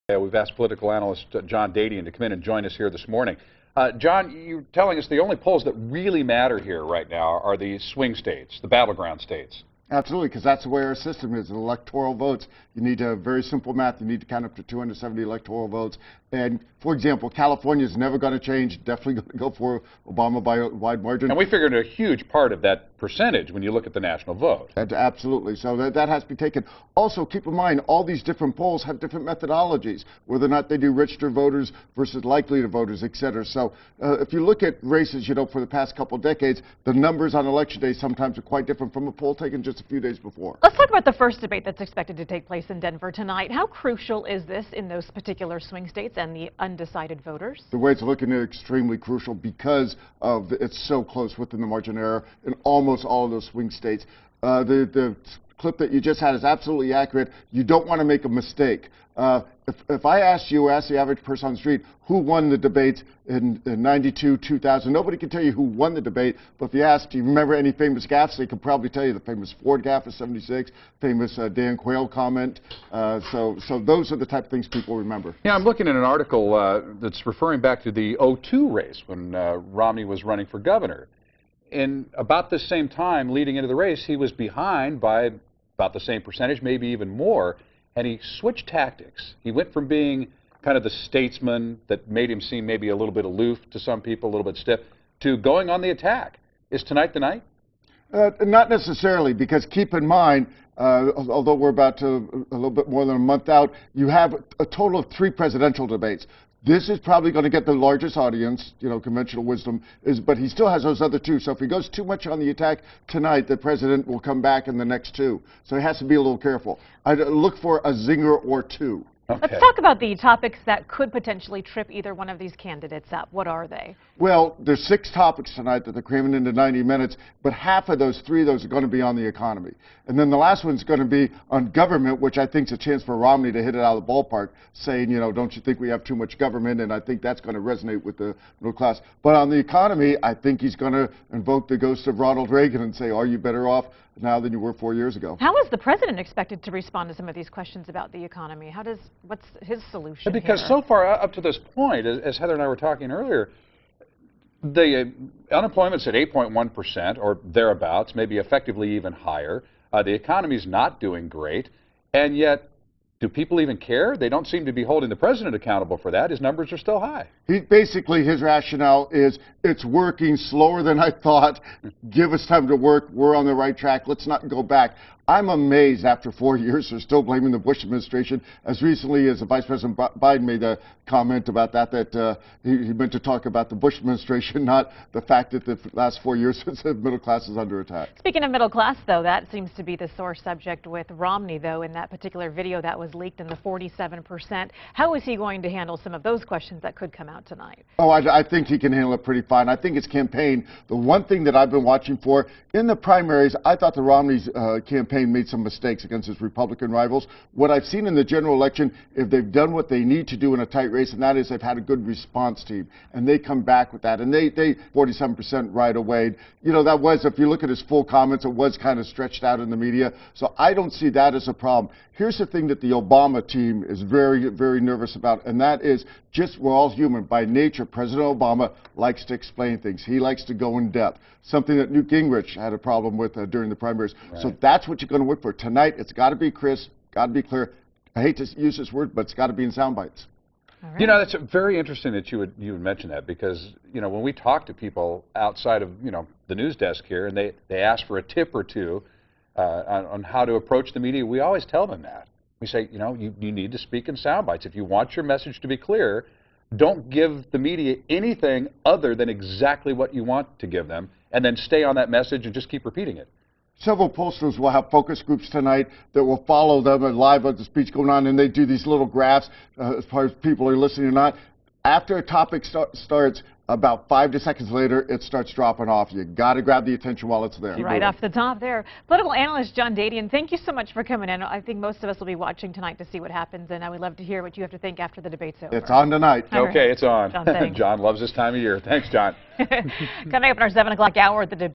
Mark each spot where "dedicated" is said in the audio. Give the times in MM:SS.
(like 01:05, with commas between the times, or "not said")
not said.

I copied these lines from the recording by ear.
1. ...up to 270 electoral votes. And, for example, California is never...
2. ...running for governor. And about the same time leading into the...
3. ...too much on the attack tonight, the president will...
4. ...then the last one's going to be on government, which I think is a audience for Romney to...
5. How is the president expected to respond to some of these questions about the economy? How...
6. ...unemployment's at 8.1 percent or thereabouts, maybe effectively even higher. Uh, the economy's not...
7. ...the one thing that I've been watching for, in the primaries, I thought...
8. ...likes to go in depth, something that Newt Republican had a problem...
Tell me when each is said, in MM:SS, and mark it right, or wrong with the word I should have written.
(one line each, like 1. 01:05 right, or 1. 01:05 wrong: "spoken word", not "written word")
1. 00:14 right
2. 01:20 right
3. 01:51 right
4. 02:10 wrong: "chance", not "audience"
5. 02:25 right
6. 02:35 right
7. 03:20 right
8. 03:50 wrong: "Gingrich", not "Republican".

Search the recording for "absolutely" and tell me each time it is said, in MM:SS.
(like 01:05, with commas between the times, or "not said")
00:09, 00:24, 00:56.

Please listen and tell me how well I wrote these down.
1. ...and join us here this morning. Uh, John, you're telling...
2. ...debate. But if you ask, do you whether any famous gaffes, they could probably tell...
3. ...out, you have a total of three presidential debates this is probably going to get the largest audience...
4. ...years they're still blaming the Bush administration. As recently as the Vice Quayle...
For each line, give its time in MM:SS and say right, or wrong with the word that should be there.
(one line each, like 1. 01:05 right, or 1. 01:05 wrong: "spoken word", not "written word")
1. 00:02 right
2. 01:06 wrong: "remember", not "whether"
3. 01:43 right
4. 02:56 wrong: "President", not "Quayle".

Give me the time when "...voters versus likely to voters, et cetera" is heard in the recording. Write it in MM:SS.
00:31.